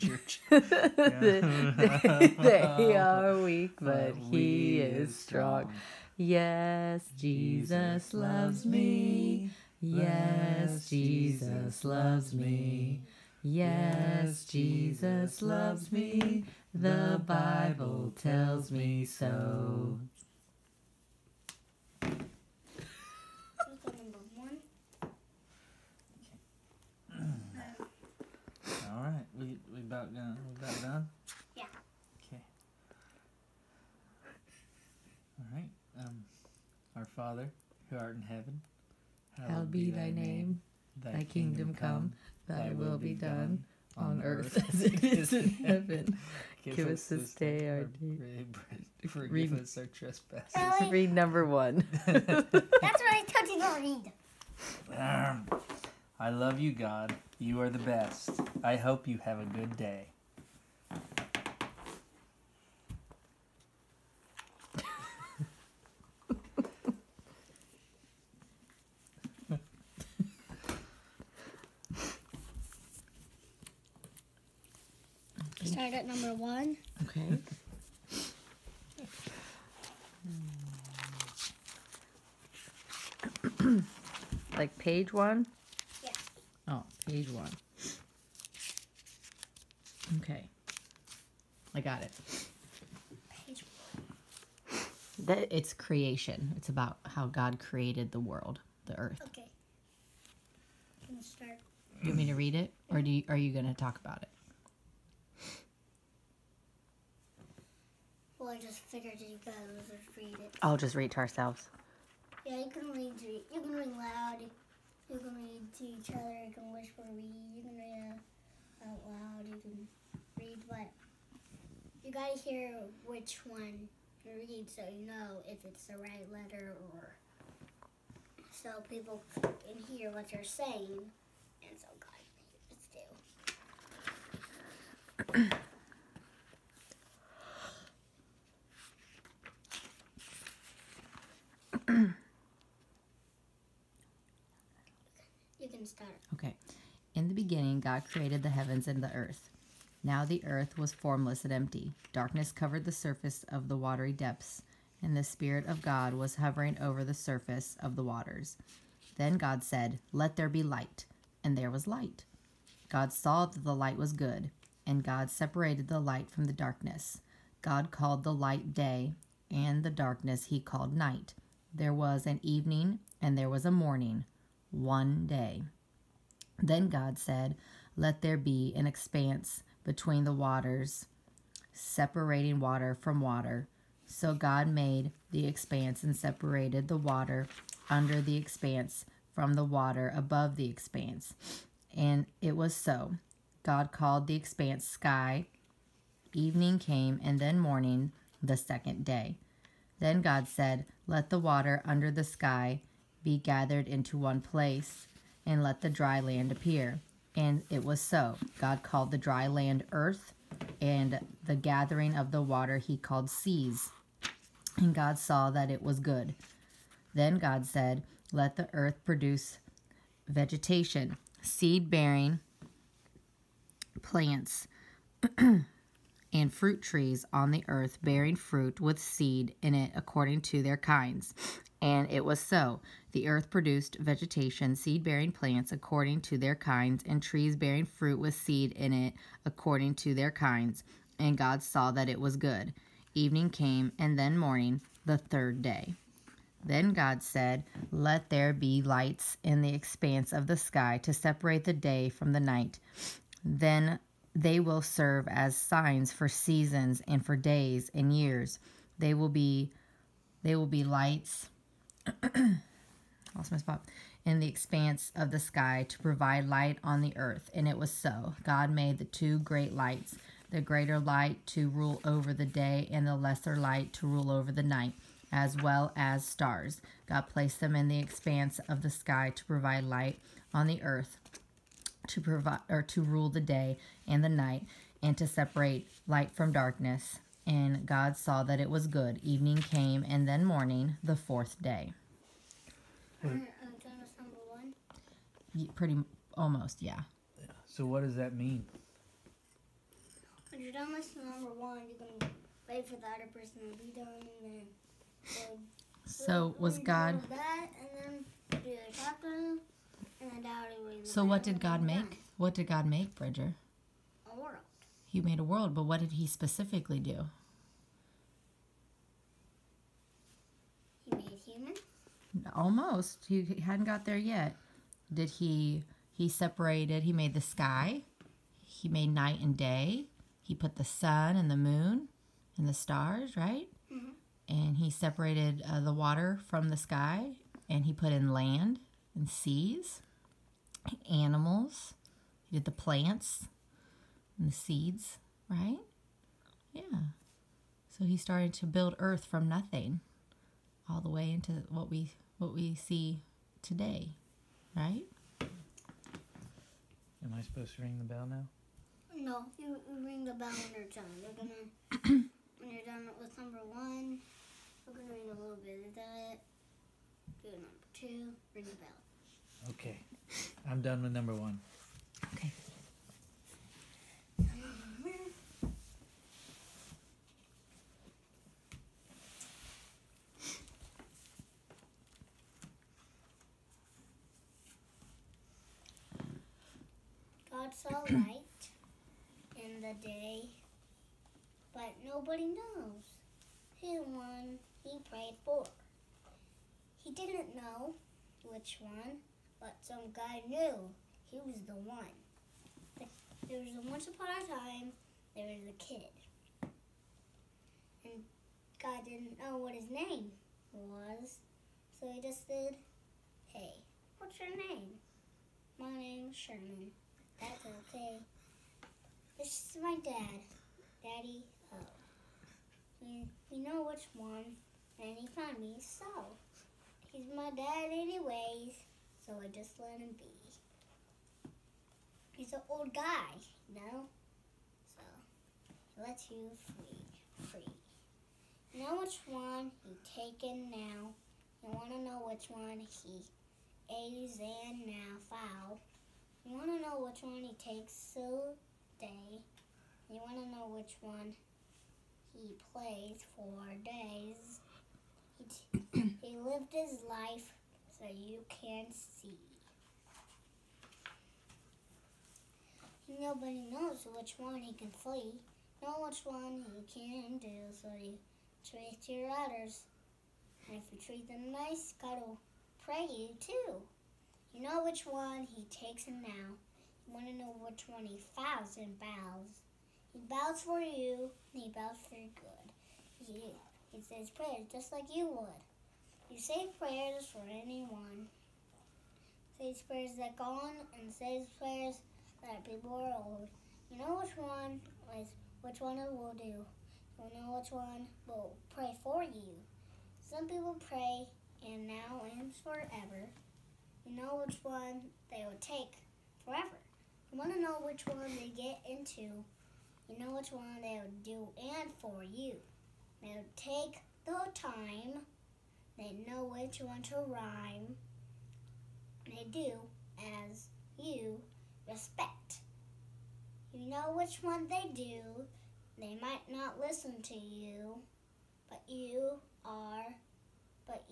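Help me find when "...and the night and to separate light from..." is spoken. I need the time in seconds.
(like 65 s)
284 s.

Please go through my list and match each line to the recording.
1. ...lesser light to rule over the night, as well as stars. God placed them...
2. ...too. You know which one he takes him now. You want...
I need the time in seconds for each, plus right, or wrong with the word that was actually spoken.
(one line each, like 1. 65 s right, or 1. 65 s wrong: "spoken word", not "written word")
1. 273 s right
2. 473 s right.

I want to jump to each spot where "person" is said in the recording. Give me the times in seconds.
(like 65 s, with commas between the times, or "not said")
303 s.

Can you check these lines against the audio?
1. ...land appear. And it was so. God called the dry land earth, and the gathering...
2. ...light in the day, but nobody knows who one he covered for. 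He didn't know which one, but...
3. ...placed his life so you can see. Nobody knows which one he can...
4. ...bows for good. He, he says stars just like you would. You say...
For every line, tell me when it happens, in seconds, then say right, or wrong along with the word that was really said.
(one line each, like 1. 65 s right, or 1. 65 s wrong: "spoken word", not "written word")
1. 206 s right
2. 388 s wrong: "prayed", not "covered"
3. 456 s wrong: "lived", not "placed"
4. 481 s wrong: "prayers", not "stars".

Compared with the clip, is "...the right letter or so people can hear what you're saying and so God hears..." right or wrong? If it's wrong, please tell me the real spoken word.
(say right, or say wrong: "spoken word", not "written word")
right.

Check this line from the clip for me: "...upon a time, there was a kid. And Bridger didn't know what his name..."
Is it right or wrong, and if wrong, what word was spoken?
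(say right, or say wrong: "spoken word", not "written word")
wrong: "God", not "Bridger".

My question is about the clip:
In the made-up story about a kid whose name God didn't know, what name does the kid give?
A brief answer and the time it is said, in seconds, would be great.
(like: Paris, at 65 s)
Sherman, at 416 s.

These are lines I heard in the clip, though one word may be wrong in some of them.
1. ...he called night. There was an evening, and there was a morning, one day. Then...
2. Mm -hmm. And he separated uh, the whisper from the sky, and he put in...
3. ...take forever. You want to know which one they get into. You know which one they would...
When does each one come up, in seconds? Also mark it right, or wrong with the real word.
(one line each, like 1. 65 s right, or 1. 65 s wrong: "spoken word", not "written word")
1. 170 s right
2. 333 s wrong: "water", not "whisper"
3. 505 s right.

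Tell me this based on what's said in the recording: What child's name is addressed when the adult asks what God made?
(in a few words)
Bridger.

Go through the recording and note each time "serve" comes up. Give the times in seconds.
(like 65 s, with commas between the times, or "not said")
254 s.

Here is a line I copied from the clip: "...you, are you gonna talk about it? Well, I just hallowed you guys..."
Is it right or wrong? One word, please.
wrong.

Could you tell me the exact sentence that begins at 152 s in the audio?
Darkness covered the surface of the watery depths, and the Spirit of God was hovering over the surface of the waters.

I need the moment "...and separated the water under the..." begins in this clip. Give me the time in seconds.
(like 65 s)
186 s.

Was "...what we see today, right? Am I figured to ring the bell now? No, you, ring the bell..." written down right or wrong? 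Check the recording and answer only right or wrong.
wrong.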